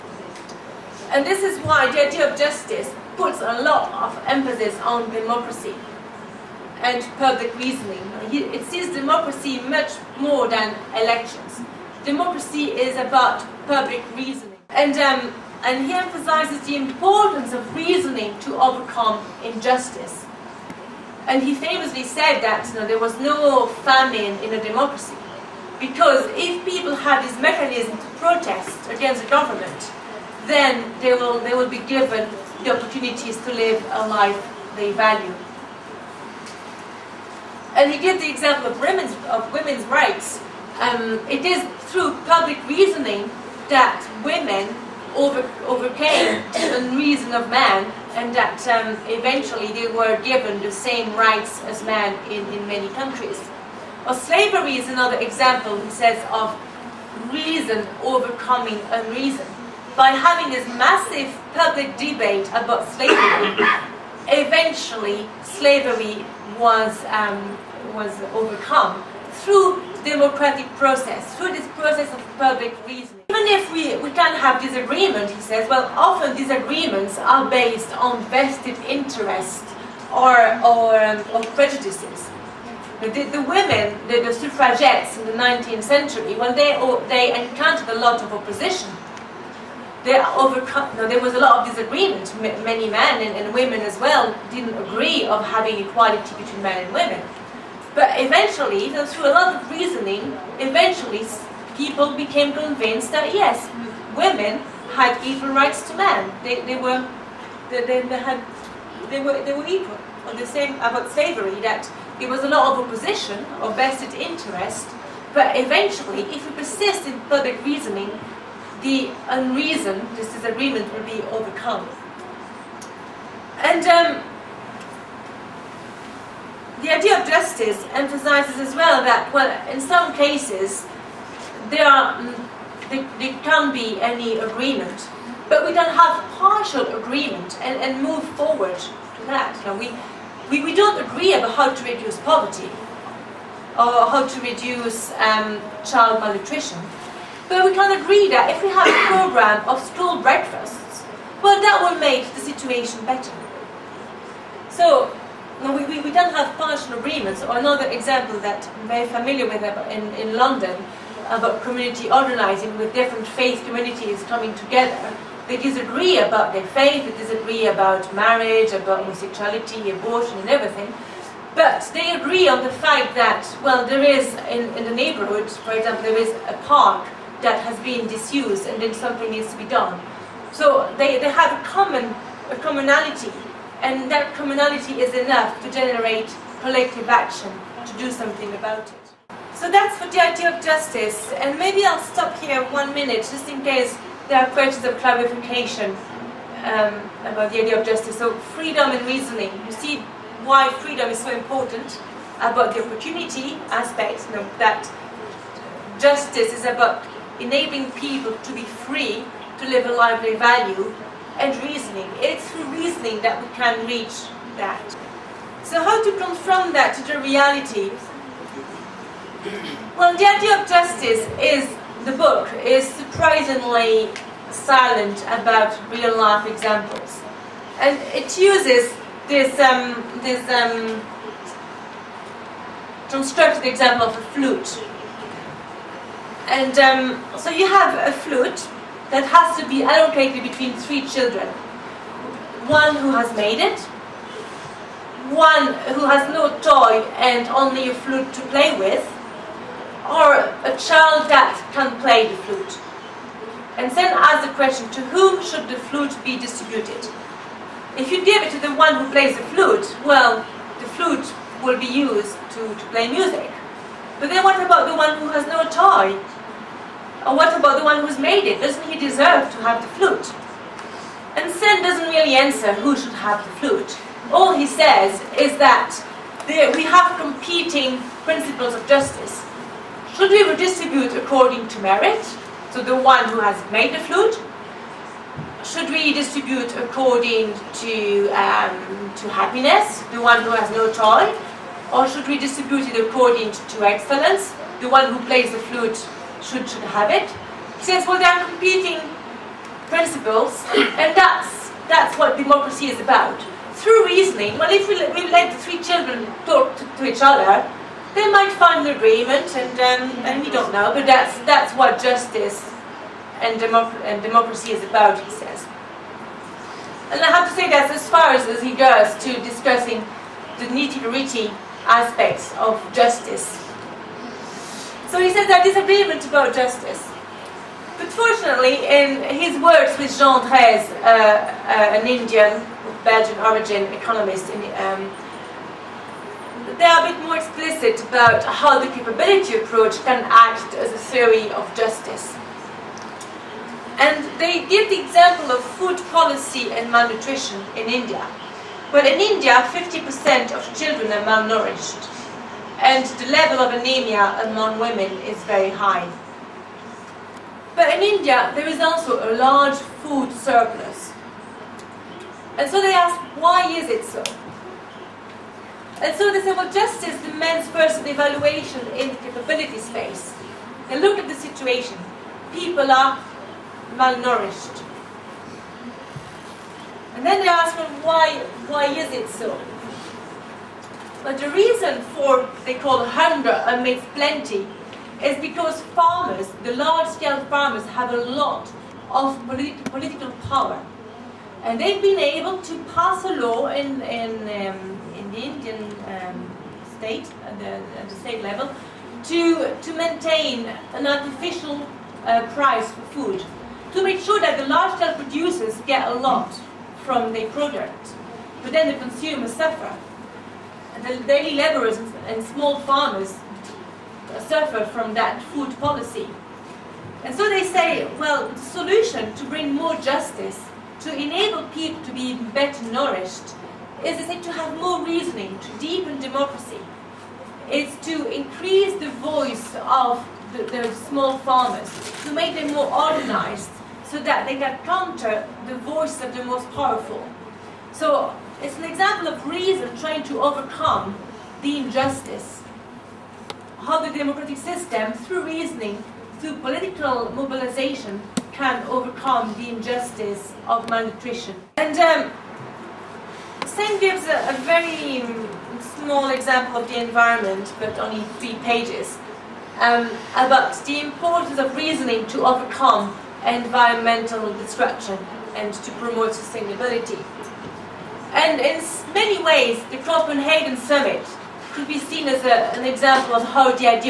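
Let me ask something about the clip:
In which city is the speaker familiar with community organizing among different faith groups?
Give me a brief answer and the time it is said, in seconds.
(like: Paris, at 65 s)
London, at 160 s.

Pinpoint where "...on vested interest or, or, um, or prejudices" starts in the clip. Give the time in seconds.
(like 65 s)
77 s.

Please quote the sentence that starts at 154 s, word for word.
So no, we, we, we, don't have partial agreements.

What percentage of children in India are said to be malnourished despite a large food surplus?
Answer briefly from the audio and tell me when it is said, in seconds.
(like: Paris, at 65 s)
50%, at 349 s.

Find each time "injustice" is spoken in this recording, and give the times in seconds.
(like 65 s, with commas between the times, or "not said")
19 s, 441 s, 449 s.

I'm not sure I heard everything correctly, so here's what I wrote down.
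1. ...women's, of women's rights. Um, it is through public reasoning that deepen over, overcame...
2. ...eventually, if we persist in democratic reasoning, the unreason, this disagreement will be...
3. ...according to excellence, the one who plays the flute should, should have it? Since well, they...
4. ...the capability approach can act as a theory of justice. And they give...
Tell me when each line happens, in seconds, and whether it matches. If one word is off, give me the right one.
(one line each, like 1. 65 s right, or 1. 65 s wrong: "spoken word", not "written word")
1. 38 s wrong: "women", not "deepen"
2. 115 s wrong: "public", not "democratic"
3. 293 s right
4. 338 s right.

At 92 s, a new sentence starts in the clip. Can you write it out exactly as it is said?
M many men and, and women as well didn't agree of having equality between men and women.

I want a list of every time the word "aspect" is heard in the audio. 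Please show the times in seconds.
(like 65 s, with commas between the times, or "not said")
203 s, 321 s.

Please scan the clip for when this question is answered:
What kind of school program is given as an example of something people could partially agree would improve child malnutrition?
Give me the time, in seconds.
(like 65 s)
149 s.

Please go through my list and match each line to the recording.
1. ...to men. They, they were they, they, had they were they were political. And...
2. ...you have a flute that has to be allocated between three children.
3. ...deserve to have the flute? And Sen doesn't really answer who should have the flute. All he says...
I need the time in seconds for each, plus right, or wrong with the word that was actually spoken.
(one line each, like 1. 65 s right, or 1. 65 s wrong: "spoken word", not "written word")
1. 105 s wrong: "equal", not "political"
2. 237 s right
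3. 268 s right.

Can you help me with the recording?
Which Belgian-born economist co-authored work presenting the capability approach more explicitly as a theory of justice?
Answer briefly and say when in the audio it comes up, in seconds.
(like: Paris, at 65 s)
Jean Drèze, at 330 s.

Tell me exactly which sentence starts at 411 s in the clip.
The daily laborers and small farmers suffer from that food policy.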